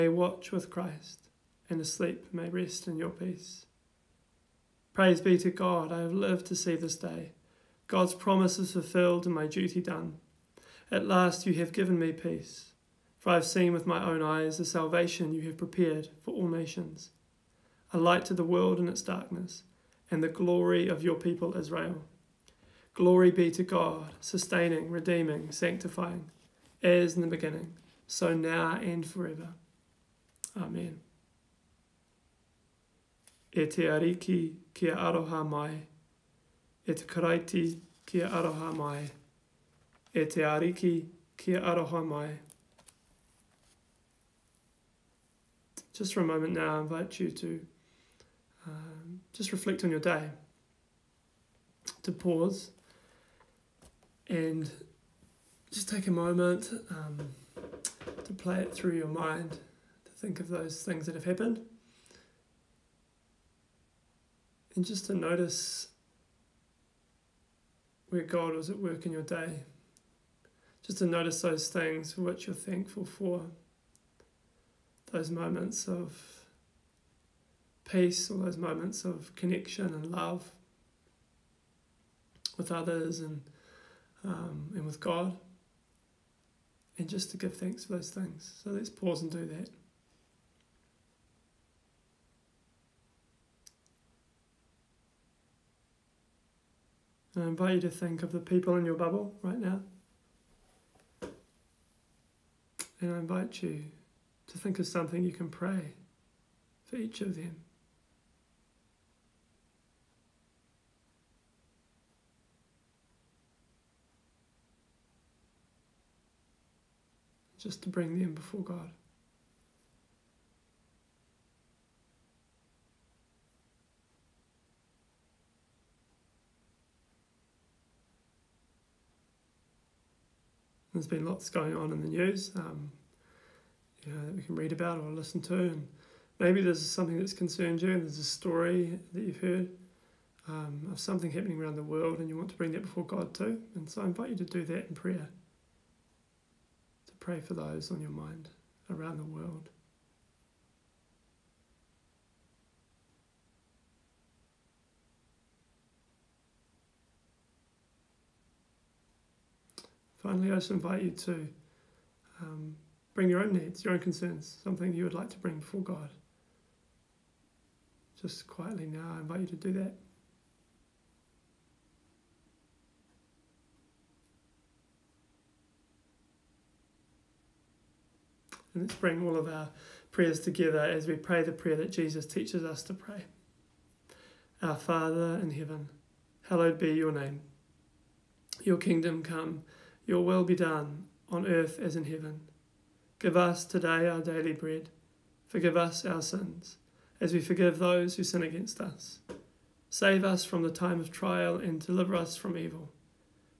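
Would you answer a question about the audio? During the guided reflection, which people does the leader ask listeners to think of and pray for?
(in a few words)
people in your bubble.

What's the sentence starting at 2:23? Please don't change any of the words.
And so I invite you to do that in prayer, to pray for those on your mind around the world.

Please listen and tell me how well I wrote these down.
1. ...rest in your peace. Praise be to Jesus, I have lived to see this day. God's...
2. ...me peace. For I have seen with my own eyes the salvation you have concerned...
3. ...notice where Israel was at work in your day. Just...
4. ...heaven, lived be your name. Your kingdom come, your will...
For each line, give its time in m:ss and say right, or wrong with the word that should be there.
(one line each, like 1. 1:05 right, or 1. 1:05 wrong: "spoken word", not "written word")
1. 0:02 wrong: "God", not "Jesus"
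2. 0:11 wrong: "prepared", not "concerned"
3. 1:05 wrong: "God", not "Israel"
4. 3:05 wrong: "hallowed", not "lived".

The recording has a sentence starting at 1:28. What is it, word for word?
So let's pause and do that.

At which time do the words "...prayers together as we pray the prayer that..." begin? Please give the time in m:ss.
3:00.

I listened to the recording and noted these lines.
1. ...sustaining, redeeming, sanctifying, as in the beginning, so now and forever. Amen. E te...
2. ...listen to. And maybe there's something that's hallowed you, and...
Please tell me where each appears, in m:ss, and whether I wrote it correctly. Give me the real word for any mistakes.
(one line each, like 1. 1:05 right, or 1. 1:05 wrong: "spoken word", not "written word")
1. 0:24 right
2. 2:15 wrong: "concerned", not "hallowed".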